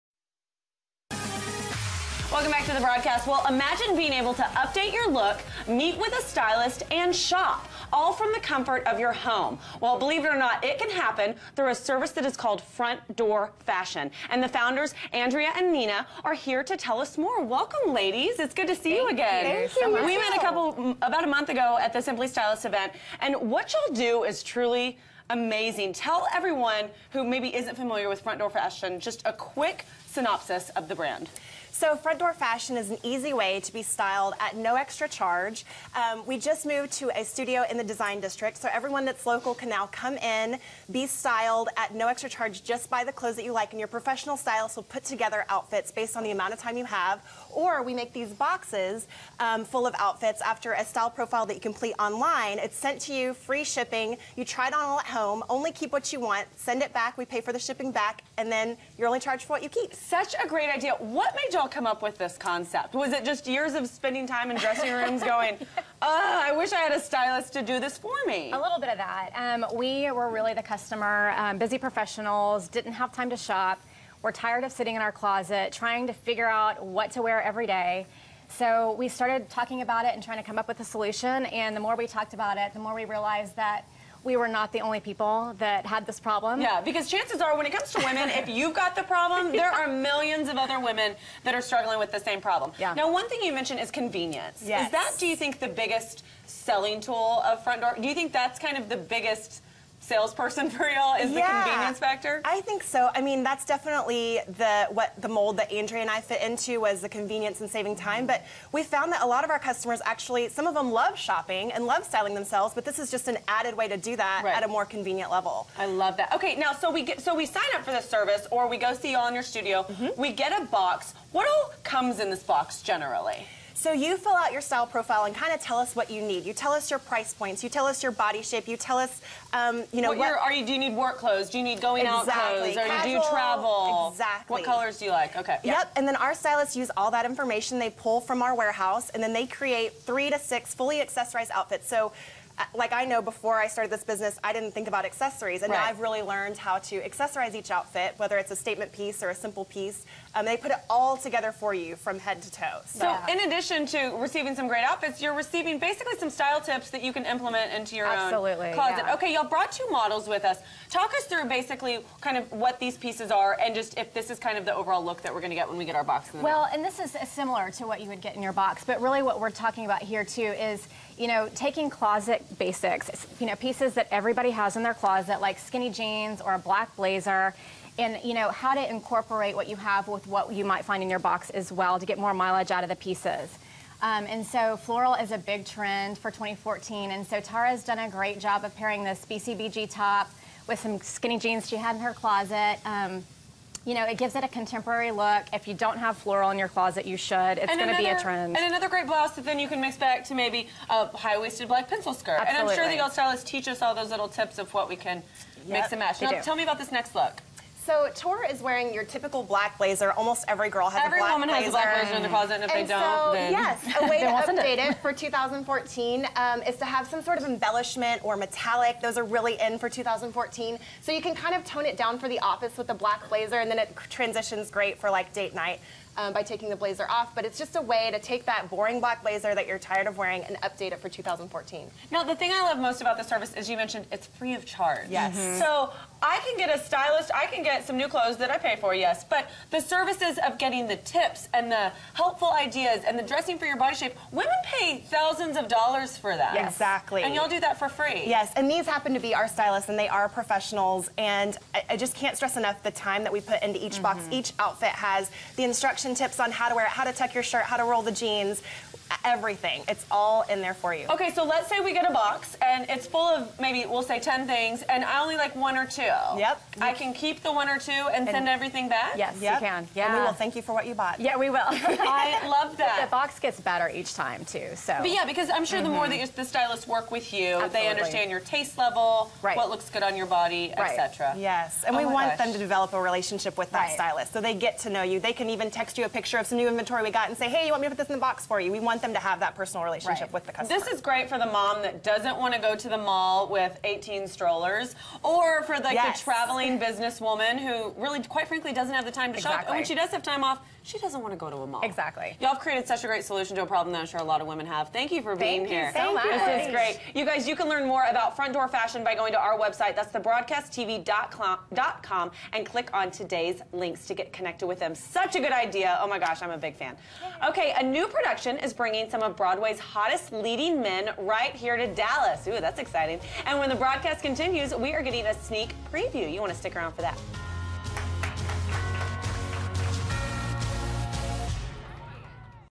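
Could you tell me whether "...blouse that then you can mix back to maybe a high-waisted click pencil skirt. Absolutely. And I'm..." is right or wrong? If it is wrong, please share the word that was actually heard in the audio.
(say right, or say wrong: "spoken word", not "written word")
wrong: "black", not "click".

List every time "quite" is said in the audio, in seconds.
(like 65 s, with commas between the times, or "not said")
298 s.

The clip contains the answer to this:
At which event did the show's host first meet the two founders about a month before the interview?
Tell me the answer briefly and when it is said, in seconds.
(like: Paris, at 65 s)
Simply Stylist, at 22 s.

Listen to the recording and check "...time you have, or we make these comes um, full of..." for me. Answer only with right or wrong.
wrong.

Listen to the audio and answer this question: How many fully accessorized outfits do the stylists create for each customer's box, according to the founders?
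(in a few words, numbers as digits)
3 to 6.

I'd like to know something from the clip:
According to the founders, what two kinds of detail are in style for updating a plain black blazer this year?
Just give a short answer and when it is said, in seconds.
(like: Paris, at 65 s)
embellishment or metallic, at 217 s.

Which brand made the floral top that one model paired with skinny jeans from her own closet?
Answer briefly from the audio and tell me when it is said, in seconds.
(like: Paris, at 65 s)
BCBG, at 189 s.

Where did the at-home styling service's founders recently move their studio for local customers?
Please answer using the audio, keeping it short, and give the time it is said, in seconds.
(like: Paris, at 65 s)
the design district, at 37 s.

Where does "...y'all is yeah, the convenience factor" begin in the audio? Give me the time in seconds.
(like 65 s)
100 s.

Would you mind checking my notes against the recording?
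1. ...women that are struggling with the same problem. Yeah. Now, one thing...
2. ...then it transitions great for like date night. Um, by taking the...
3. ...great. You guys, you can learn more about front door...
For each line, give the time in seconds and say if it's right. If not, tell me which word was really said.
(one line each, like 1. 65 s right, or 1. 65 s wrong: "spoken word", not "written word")
1. 90 s right
2. 223 s right
3. 306 s right.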